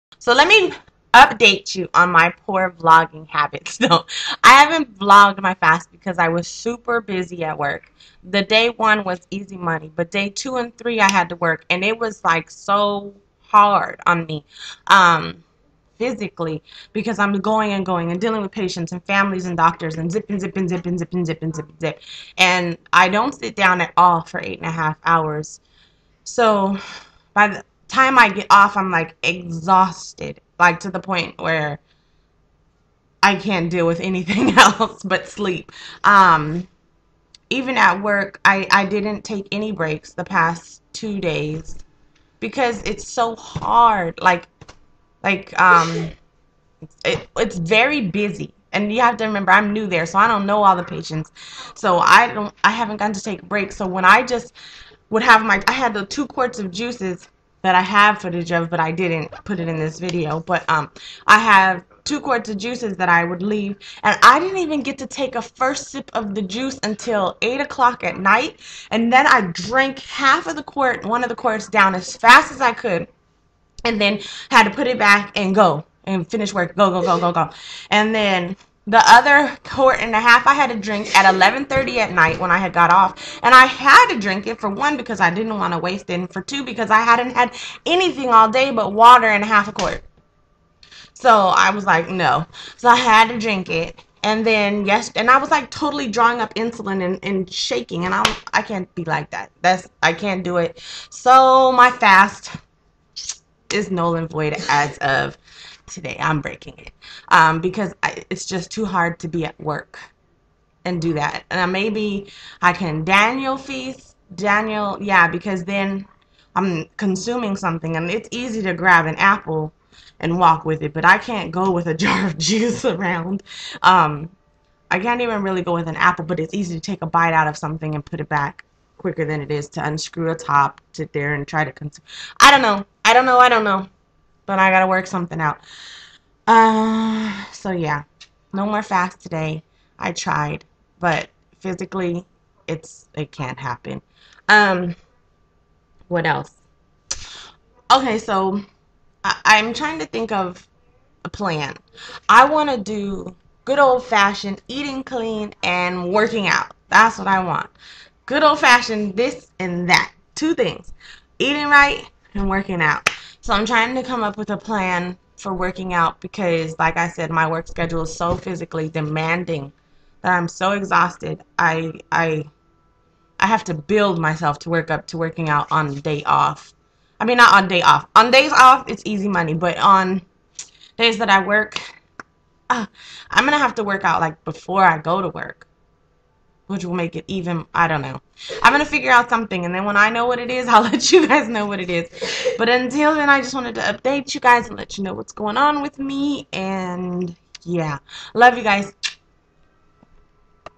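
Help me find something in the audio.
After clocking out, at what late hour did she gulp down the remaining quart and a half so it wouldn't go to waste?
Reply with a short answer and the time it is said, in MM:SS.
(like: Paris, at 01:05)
11:30 PM, at 01:21.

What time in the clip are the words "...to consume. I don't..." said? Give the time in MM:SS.
02:11.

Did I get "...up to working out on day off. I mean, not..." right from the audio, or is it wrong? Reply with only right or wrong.
right.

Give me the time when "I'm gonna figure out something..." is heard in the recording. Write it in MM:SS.
03:08.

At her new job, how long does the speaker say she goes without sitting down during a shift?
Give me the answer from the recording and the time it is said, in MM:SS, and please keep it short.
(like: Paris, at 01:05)
8.5 hours, at 00:24.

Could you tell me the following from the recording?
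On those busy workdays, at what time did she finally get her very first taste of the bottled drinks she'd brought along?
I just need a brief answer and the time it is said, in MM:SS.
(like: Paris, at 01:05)
8:00 PM, at 01:07.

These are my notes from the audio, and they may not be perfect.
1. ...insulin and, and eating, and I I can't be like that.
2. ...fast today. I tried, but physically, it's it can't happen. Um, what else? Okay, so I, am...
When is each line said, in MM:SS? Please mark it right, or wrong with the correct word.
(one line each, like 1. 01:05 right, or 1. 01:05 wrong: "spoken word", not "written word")
1. 01:36 wrong: "shaking", not "eating"
2. 02:18 right.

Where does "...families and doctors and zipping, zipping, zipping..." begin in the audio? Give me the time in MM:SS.
00:19.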